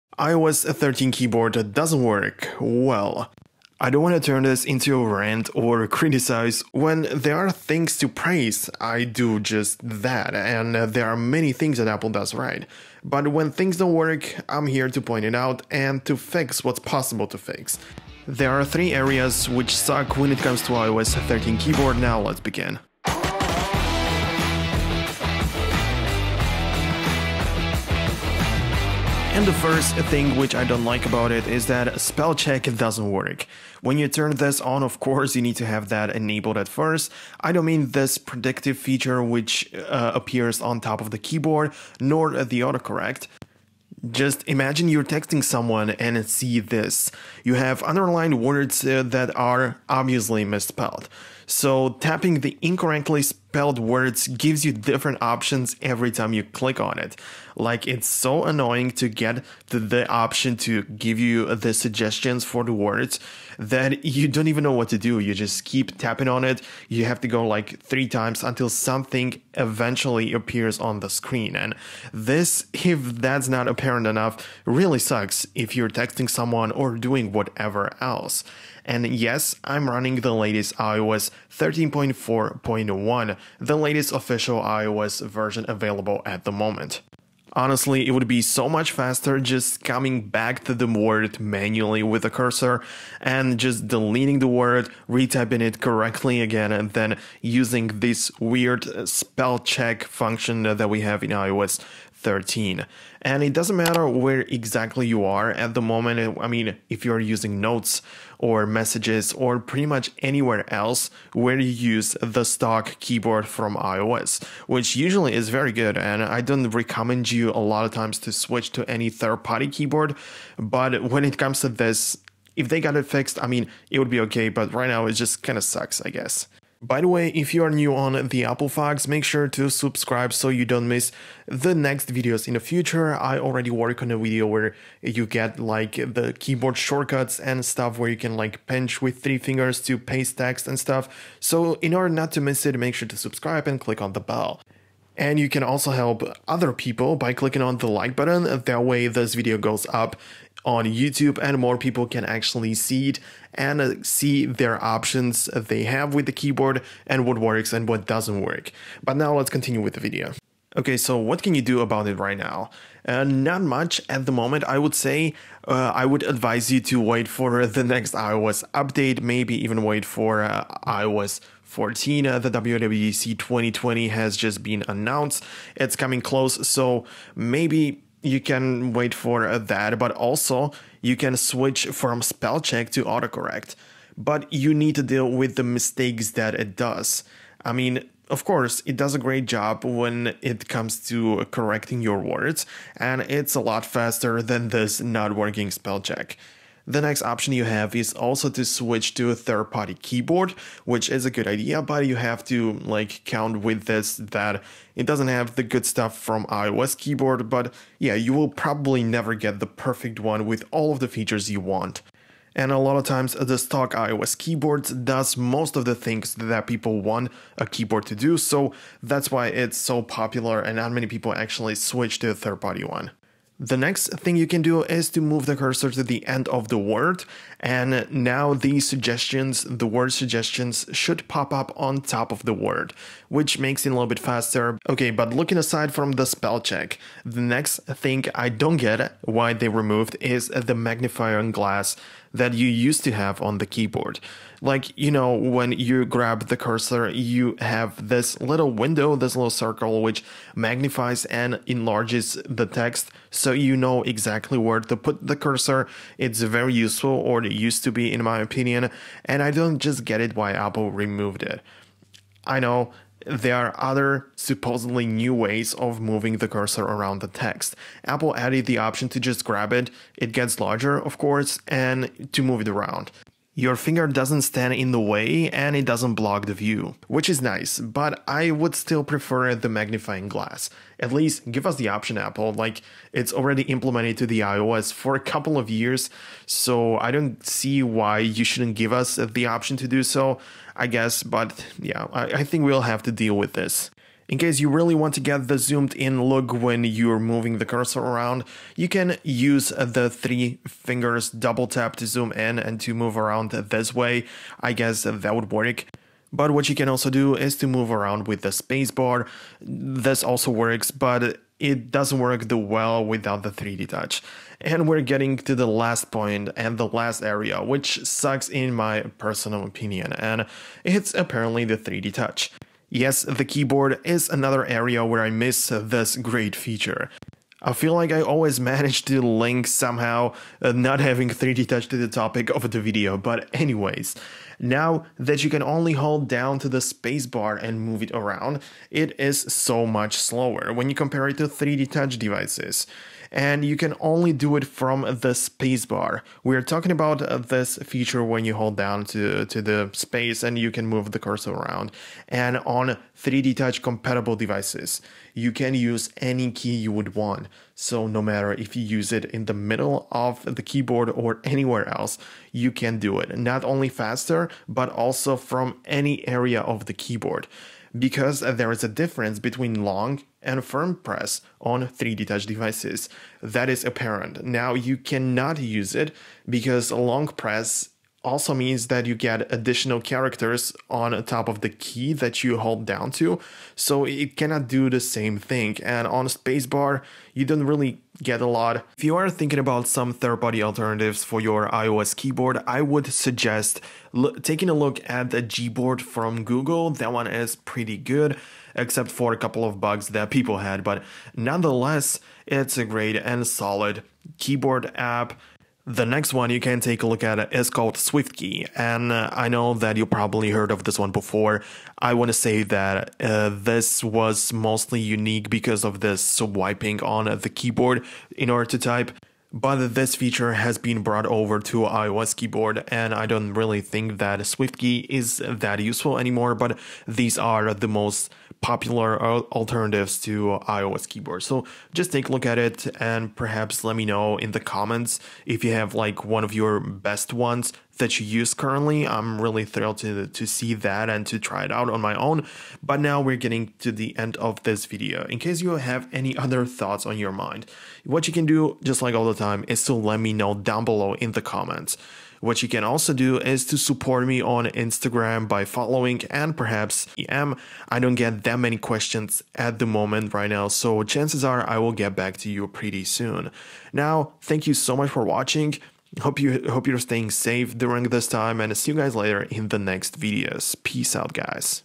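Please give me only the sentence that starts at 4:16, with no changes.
It's very useful, or it used to be, in my opinion, and I don't just get it why Apple removed it.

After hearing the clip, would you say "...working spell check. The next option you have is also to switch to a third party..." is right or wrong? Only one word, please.
right.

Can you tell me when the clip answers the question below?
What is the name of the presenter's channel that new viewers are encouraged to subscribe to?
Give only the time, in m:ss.
2:08.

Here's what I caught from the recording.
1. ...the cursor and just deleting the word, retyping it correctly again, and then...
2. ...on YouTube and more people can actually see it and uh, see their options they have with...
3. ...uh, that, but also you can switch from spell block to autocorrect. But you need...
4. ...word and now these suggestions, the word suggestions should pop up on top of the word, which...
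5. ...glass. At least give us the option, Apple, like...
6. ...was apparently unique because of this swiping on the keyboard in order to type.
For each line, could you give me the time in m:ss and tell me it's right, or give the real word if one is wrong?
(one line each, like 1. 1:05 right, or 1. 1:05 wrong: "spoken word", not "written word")
1. 1:32 right
2. 2:30 right
3. 2:59 wrong: "check", not "block"
4. 3:46 right
5. 4:40 right
6. 6:54 wrong: "mostly", not "apparently".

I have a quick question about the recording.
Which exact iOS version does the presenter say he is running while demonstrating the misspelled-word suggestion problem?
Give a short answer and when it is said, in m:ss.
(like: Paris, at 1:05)
iOS 13.4.1, at 1:20.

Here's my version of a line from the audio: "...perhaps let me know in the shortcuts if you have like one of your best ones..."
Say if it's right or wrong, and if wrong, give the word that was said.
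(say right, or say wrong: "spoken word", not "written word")
wrong: "comments", not "shortcuts".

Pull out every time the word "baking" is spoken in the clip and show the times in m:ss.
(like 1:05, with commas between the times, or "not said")
not said.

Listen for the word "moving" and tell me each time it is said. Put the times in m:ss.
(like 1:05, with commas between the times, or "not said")
4:25, 4:57.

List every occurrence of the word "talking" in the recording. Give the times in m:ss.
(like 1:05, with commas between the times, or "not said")
5:46.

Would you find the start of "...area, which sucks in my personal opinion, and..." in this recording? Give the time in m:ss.
5:17.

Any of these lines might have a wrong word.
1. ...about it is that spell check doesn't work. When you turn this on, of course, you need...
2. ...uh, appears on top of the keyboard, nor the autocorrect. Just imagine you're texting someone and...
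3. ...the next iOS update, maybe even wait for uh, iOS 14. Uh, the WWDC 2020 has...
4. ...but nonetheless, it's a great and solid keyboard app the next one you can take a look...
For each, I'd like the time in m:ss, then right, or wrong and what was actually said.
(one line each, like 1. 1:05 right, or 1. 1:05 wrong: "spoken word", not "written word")
1. 0:31 right
2. 0:39 right
3. 2:47 right
4. 6:40 right.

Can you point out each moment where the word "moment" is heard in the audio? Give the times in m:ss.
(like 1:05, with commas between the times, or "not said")
1:26, 1:45, 2:44, 7:39.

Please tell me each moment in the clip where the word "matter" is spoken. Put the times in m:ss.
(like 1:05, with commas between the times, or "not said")
1:43, 5:58.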